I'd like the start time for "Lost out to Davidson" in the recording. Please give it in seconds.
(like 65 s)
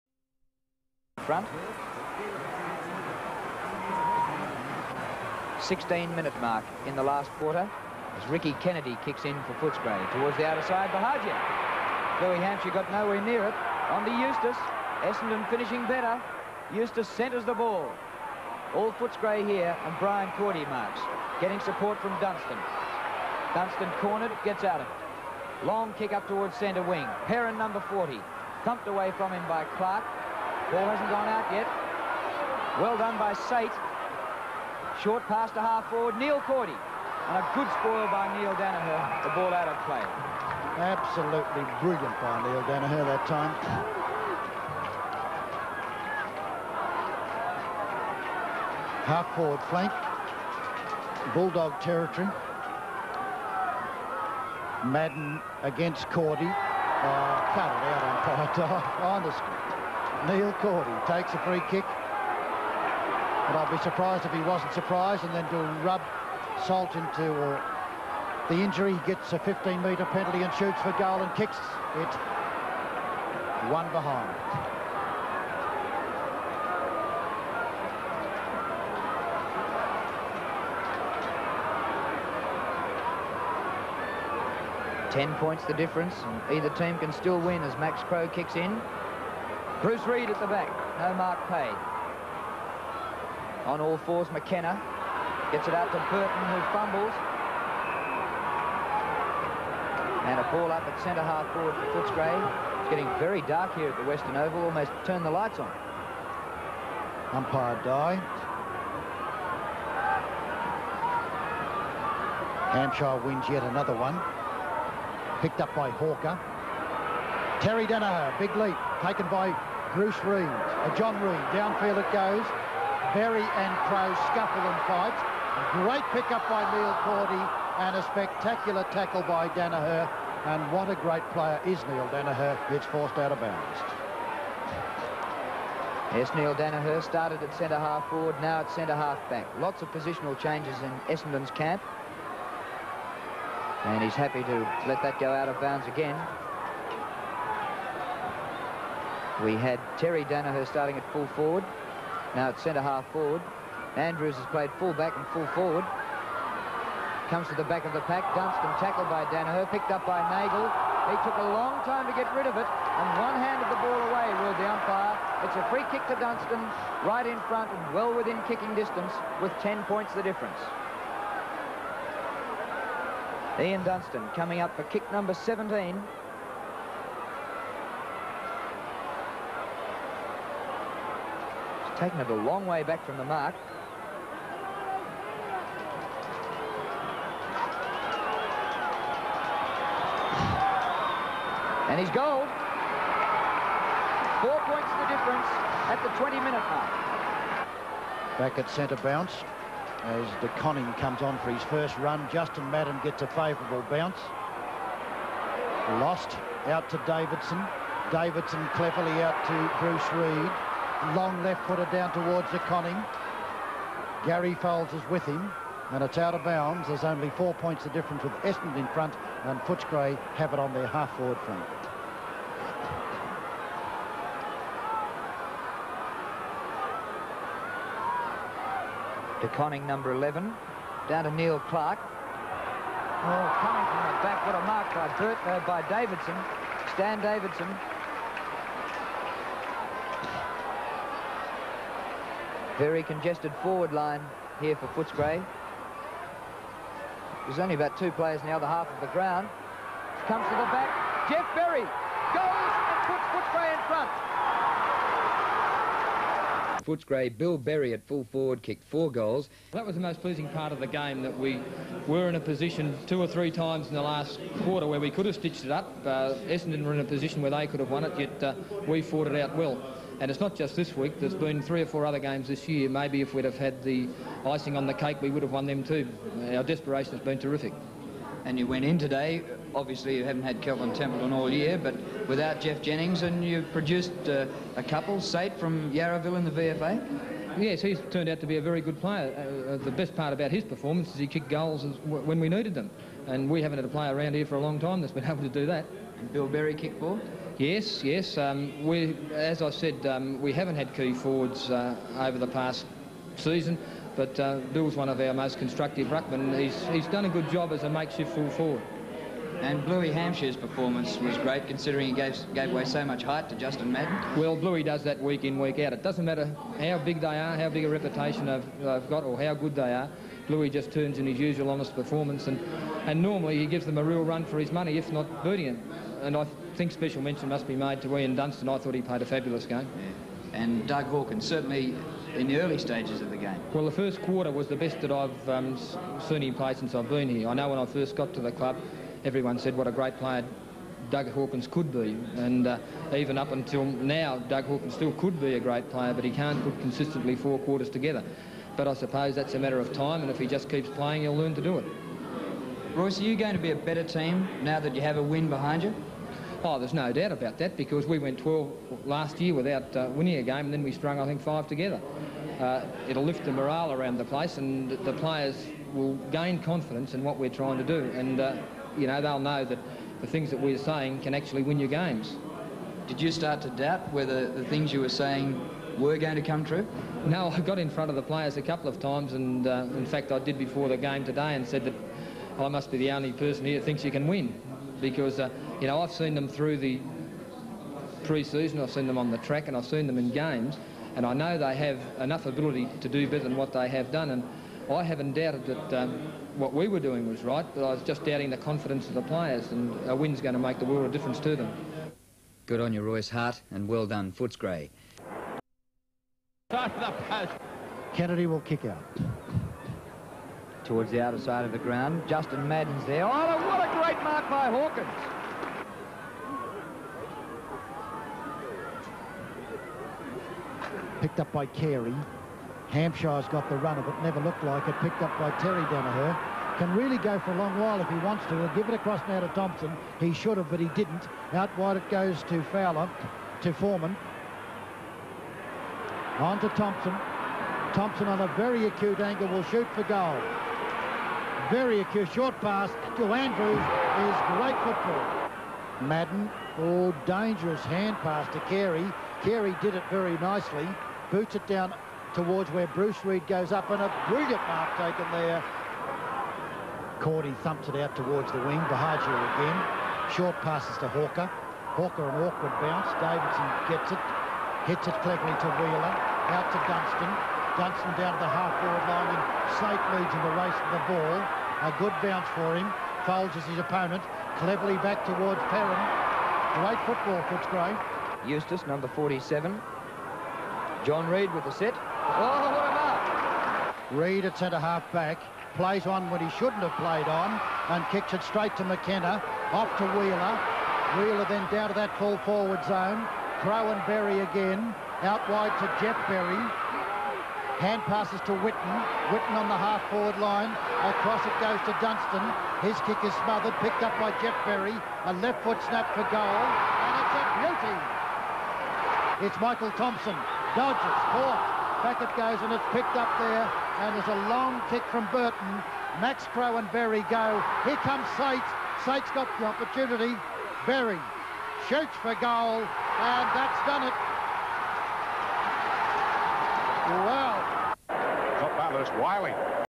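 206 s.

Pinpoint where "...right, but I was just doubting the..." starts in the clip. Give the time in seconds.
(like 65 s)
397 s.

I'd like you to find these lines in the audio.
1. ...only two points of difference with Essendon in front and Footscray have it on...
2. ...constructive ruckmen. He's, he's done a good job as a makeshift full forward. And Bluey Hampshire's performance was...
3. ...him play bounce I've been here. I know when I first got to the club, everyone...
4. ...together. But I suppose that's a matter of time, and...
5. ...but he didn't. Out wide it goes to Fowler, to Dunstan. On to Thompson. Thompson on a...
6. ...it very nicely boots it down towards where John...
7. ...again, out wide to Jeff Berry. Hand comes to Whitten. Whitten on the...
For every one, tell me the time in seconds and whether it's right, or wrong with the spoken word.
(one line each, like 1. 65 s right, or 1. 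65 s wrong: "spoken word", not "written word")
1. 217 s wrong: "four", not "two"
2. 305 s right
3. 336 s wrong: "since", not "bounce"
4. 347 s right
5. 430 s wrong: "Foreman", not "Dunstan"
6. 449 s wrong: "Bruce", not "John"
7. 494 s wrong: "passes", not "comes".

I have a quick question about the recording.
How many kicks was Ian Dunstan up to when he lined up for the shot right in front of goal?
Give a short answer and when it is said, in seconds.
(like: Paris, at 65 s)
17, at 175 s.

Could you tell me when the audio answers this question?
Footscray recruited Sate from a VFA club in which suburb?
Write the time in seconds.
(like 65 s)
285 s.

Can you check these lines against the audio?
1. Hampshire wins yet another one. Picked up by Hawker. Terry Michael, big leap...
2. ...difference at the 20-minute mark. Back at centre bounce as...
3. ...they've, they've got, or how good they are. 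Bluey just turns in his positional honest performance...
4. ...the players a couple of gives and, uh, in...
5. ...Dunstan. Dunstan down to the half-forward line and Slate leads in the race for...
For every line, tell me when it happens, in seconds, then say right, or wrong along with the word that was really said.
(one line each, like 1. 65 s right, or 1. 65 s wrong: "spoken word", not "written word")
1. 112 s wrong: "Daniher", not "Michael"
2. 195 s right
3. 318 s wrong: "usual", not "positional"
4. 378 s wrong: "times", not "gives"
5. 466 s right.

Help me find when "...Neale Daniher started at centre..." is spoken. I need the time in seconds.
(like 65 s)
136 s.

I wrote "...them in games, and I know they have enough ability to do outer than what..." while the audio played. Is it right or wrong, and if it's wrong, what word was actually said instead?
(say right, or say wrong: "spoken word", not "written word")
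wrong: "better", not "outer".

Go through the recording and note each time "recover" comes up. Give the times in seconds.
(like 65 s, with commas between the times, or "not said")
not said.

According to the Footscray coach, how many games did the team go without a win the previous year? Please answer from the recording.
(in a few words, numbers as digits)
12.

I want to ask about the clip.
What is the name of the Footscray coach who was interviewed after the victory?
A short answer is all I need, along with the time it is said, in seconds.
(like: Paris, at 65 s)
Royce Hart, at 403 s.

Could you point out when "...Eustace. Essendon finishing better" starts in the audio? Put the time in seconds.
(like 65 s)
14 s.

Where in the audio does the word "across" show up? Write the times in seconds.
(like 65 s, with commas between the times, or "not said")
428 s, 501 s.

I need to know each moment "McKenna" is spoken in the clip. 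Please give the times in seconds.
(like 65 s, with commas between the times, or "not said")
94 s, 488 s.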